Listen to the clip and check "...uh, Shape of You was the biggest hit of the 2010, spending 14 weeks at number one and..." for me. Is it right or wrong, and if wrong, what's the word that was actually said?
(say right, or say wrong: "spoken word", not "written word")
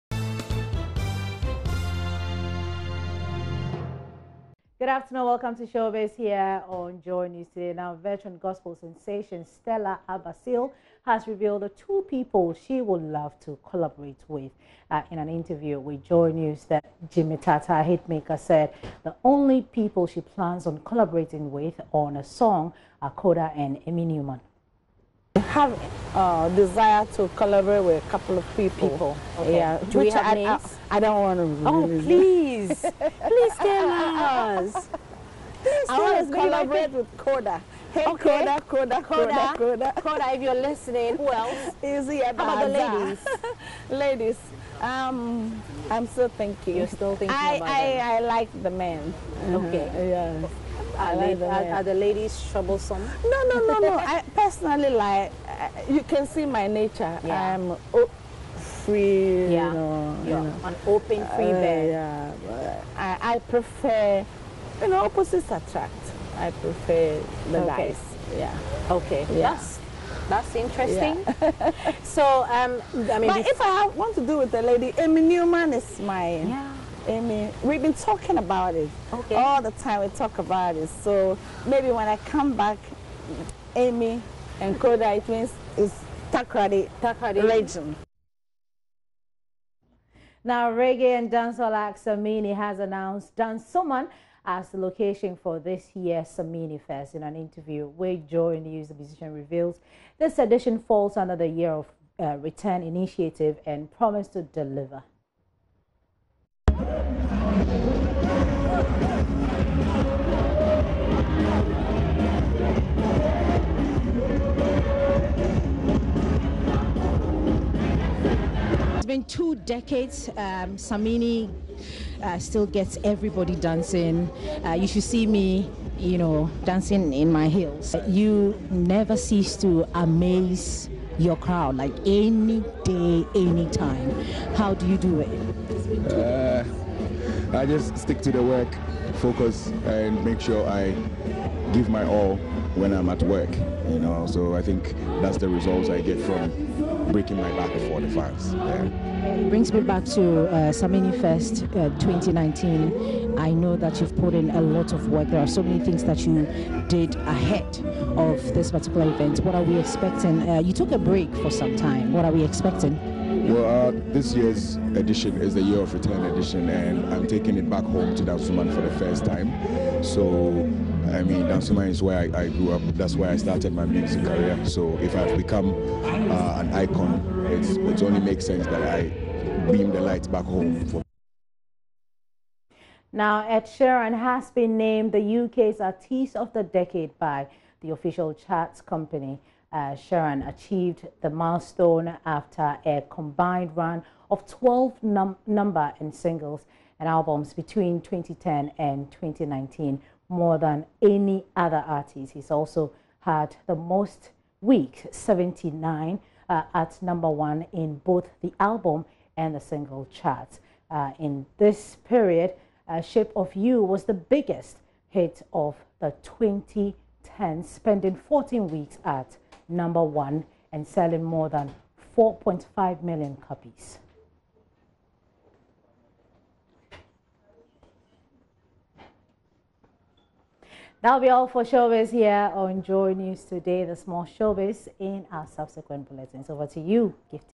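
right.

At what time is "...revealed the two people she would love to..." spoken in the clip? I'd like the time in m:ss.
0:11.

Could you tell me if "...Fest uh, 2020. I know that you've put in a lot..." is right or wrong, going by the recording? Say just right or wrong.
wrong.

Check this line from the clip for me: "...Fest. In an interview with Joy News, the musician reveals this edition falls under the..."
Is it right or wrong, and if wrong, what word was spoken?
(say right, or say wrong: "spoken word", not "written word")
right.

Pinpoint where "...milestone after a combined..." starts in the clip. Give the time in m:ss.
3:11.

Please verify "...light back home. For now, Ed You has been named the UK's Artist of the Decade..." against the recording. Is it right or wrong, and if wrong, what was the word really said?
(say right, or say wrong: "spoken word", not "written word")
wrong: "Sheeran", not "You".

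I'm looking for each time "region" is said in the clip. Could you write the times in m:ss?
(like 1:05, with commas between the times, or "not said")
1:27.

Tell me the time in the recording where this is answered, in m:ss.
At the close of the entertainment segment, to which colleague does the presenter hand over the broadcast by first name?
3:57.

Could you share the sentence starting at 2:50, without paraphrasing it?
So I mean, Dansoman is where I, I, grew up.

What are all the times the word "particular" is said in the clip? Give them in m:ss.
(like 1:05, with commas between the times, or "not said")
2:38.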